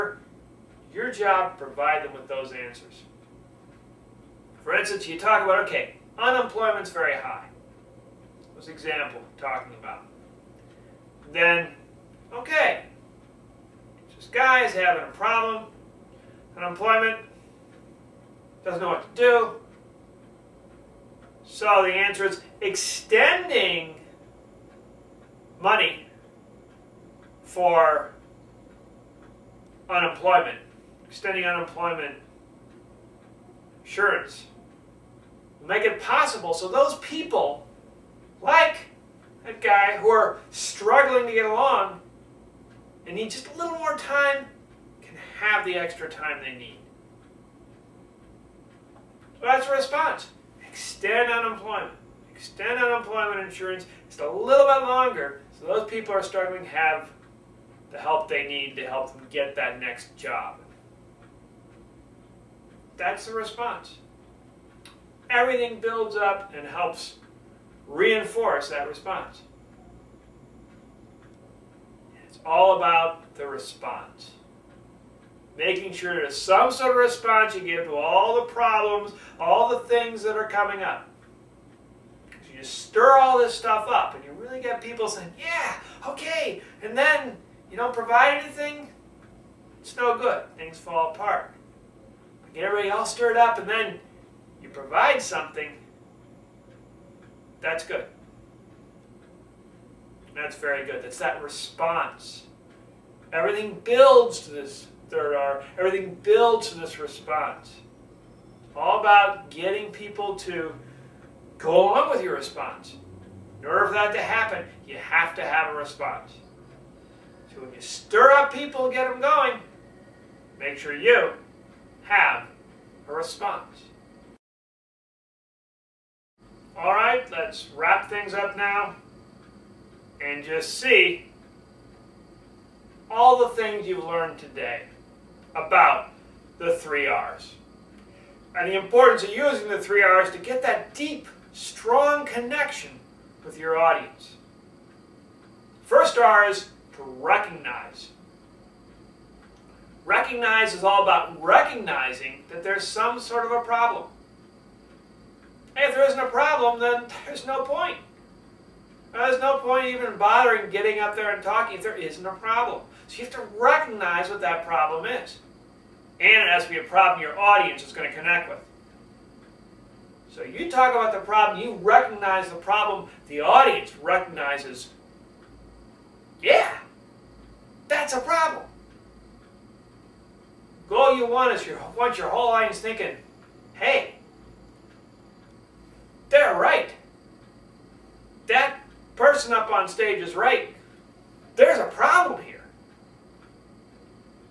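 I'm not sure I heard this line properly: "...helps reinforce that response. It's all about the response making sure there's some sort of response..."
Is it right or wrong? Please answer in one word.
right.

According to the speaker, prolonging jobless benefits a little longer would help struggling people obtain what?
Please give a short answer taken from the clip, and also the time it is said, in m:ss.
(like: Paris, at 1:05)
next job, at 0:59.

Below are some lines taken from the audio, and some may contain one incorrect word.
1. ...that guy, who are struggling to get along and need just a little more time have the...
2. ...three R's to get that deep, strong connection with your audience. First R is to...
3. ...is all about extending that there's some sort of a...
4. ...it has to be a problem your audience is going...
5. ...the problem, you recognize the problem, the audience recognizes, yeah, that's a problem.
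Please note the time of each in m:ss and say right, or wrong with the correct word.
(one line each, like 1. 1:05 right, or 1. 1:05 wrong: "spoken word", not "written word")
1. 0:39 right
2. 2:19 right
3. 2:30 wrong: "recognizing", not "extending"
4. 2:46 right
5. 2:51 right.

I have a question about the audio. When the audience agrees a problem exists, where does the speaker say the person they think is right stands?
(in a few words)
on stage.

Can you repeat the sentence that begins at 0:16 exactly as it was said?
Unemployment doesn't know what to do.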